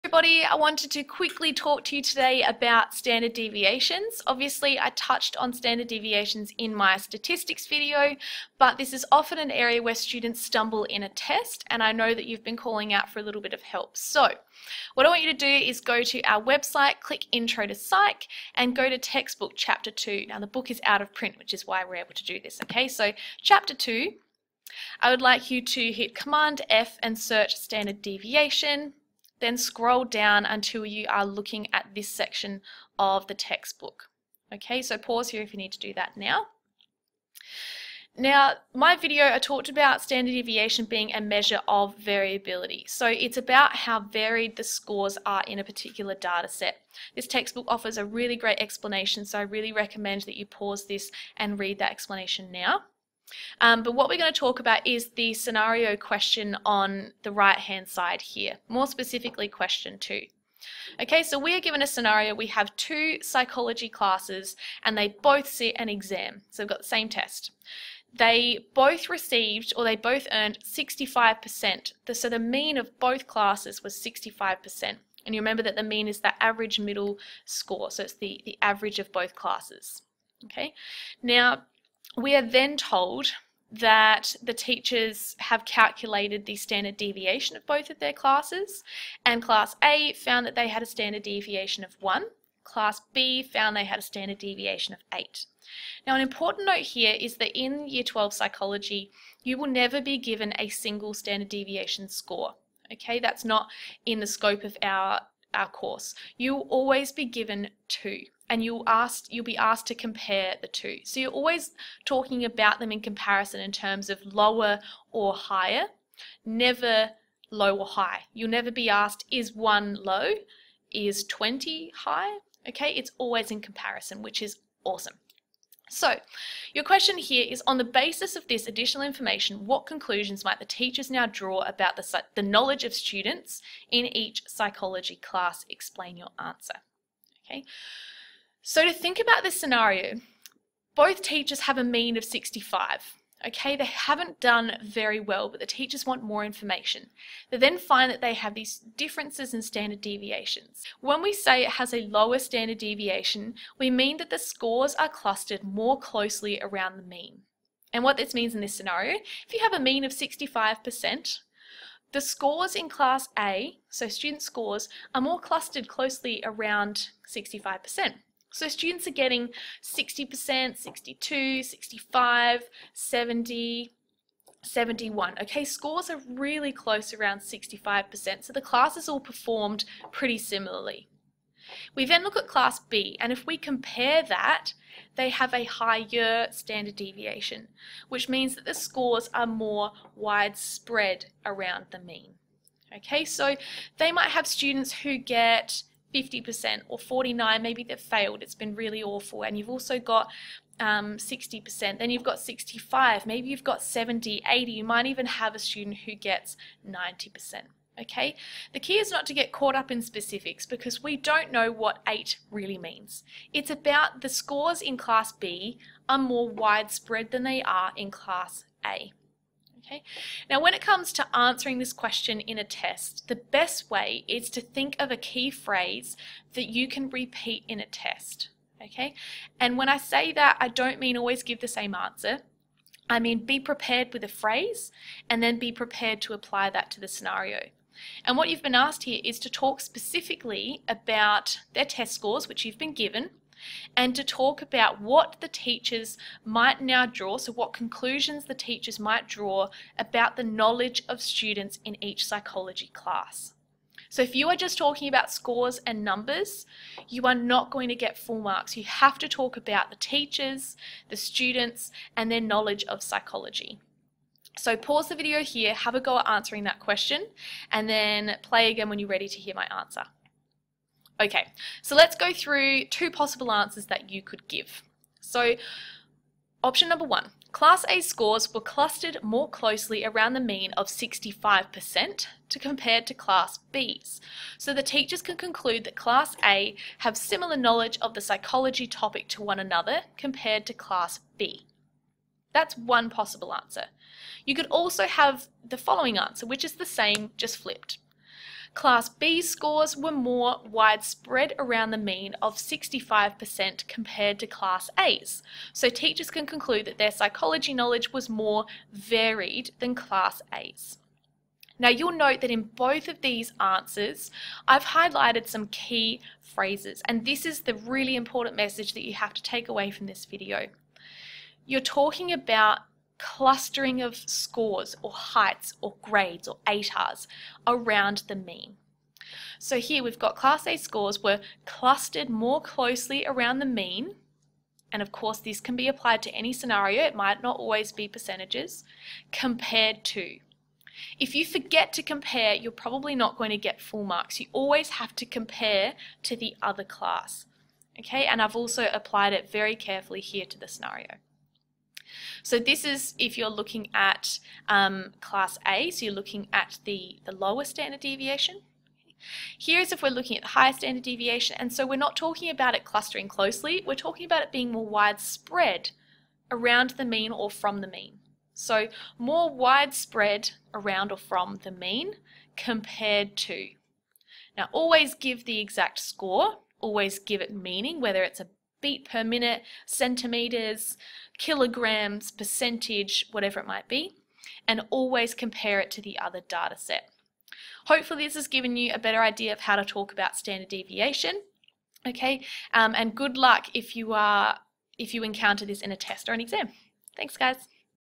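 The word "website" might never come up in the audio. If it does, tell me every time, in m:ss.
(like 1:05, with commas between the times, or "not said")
0:16.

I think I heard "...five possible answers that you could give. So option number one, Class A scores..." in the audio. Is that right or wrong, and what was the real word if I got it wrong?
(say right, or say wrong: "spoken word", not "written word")
wrong: "two", not "five".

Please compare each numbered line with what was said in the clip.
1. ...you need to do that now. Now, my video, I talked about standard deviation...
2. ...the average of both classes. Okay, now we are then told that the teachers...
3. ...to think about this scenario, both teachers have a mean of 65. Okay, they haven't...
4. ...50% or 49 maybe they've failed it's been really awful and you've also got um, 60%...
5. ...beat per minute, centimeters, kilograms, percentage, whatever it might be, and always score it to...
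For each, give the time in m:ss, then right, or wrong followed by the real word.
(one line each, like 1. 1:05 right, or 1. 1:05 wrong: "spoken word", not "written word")
1. 0:35 right
2. 1:18 right
3. 2:18 right
4. 3:16 right
5. 6:18 wrong: "compare", not "score".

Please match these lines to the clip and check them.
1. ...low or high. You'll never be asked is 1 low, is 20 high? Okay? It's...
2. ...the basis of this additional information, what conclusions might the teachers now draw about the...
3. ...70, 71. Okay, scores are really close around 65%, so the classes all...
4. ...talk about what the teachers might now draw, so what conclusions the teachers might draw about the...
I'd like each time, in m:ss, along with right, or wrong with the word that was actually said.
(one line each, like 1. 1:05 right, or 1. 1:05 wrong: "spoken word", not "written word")
1. 1:57 right
2. 2:07 right
3. 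2:52 right
4. 4:04 right.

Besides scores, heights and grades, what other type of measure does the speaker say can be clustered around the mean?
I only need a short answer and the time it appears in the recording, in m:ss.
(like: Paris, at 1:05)
ATARs, at 5:26.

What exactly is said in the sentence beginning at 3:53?
I mean, be prepared with a phrase and then be prepared to apply that to the scenario.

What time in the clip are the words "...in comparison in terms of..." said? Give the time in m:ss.
1:52.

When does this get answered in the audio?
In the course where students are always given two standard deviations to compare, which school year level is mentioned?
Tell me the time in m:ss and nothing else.
1:37.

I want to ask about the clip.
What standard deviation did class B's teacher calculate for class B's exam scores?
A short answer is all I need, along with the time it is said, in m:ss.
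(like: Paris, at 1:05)
8, at 1:34.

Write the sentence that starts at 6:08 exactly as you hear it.
So more widespread around or from the mean compared to.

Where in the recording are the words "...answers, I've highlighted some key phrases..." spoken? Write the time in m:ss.
5:13.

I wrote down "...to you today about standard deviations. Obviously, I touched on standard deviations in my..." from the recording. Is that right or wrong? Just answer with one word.
right.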